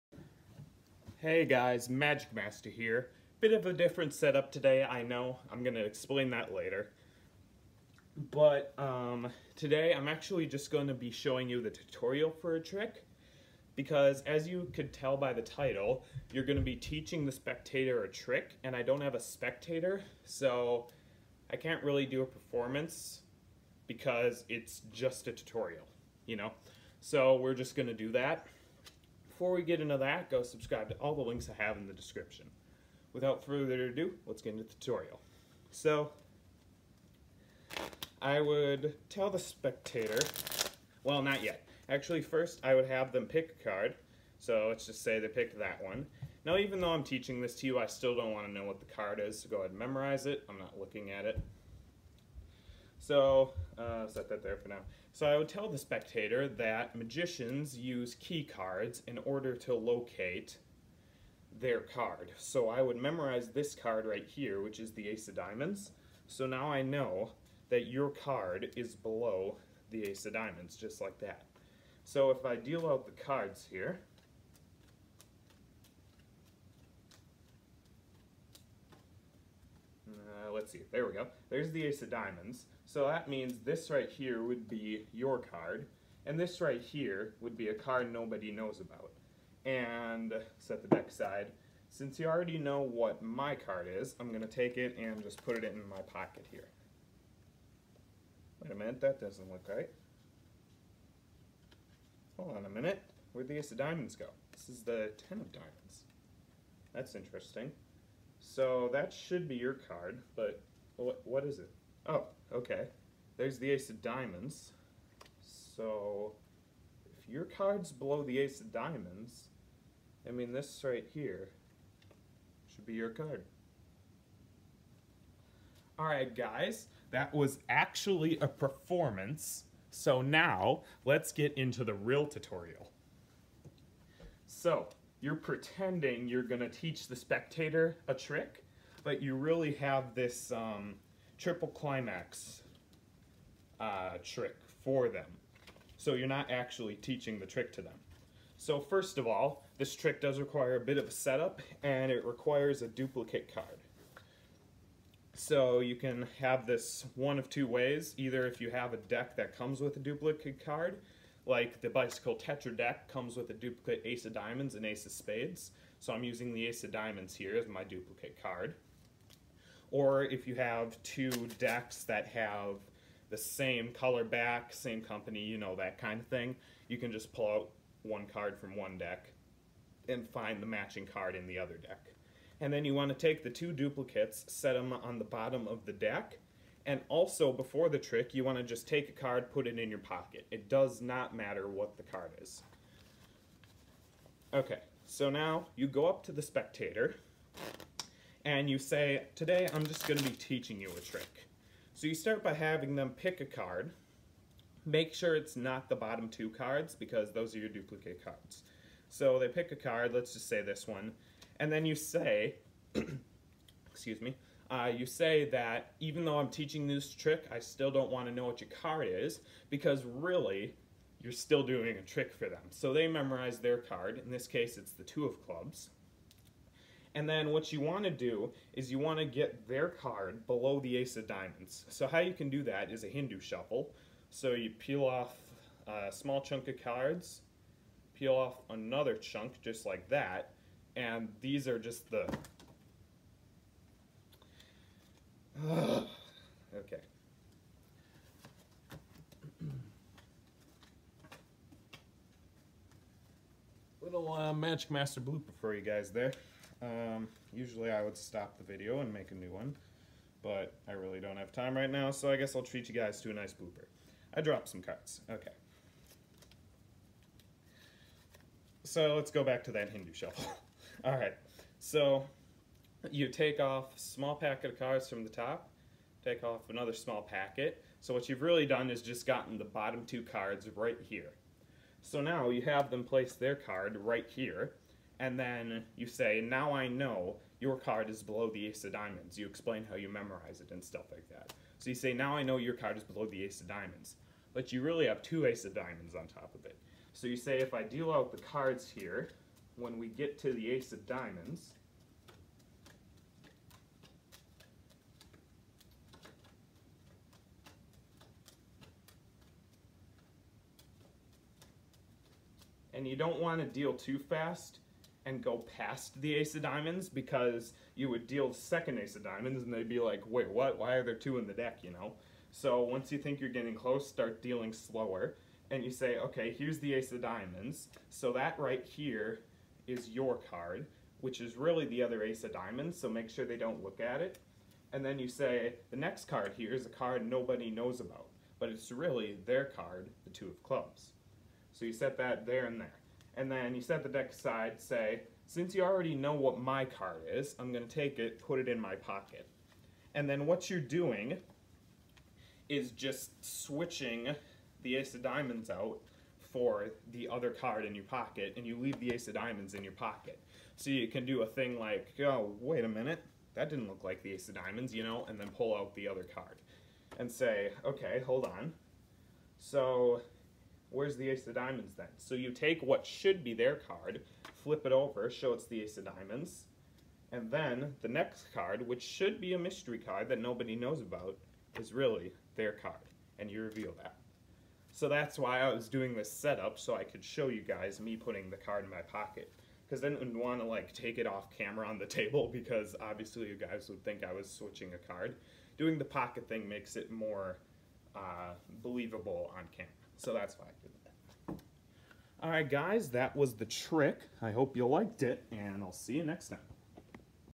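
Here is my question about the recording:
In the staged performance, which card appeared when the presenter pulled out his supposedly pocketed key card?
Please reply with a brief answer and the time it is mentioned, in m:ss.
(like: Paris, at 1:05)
Ten of Diamonds, at 1:45.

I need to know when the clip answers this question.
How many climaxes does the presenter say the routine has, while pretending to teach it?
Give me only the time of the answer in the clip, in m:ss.
2:21.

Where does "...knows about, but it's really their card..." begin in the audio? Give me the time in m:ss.
5:37.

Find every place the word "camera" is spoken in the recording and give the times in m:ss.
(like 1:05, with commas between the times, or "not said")
6:31, 6:39.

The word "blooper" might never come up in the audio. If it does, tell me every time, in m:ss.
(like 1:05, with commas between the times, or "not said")
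4:15, 4:23.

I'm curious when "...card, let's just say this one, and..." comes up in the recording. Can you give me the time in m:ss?
3:29.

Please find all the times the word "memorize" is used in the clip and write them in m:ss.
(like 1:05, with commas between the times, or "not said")
0:49, 1:02, 3:43, 4:50.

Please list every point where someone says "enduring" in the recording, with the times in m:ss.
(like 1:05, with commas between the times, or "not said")
not said.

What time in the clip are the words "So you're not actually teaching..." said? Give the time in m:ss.
2:25.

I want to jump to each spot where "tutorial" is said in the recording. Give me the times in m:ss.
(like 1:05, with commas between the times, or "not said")
0:11, 0:25, 0:34, 2:12.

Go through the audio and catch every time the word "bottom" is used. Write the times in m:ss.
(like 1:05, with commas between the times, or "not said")
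3:05, 3:25, 4:39.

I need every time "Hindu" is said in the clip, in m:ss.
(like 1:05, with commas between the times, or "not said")
3:53, 4:29.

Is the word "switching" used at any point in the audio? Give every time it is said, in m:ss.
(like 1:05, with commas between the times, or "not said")
5:53, 6:34.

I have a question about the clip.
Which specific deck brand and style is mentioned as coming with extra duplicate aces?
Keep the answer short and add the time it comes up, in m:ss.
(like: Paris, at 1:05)
Bicycle Tetra, at 2:41.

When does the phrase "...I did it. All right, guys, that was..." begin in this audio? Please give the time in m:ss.
6:40.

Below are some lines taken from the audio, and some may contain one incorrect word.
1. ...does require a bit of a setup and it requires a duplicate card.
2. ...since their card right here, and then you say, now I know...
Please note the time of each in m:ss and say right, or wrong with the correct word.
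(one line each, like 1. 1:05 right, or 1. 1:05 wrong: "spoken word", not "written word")
1. 2:30 right
2. 4:43 wrong: "place", not "since".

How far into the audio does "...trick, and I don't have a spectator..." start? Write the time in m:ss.
0:18.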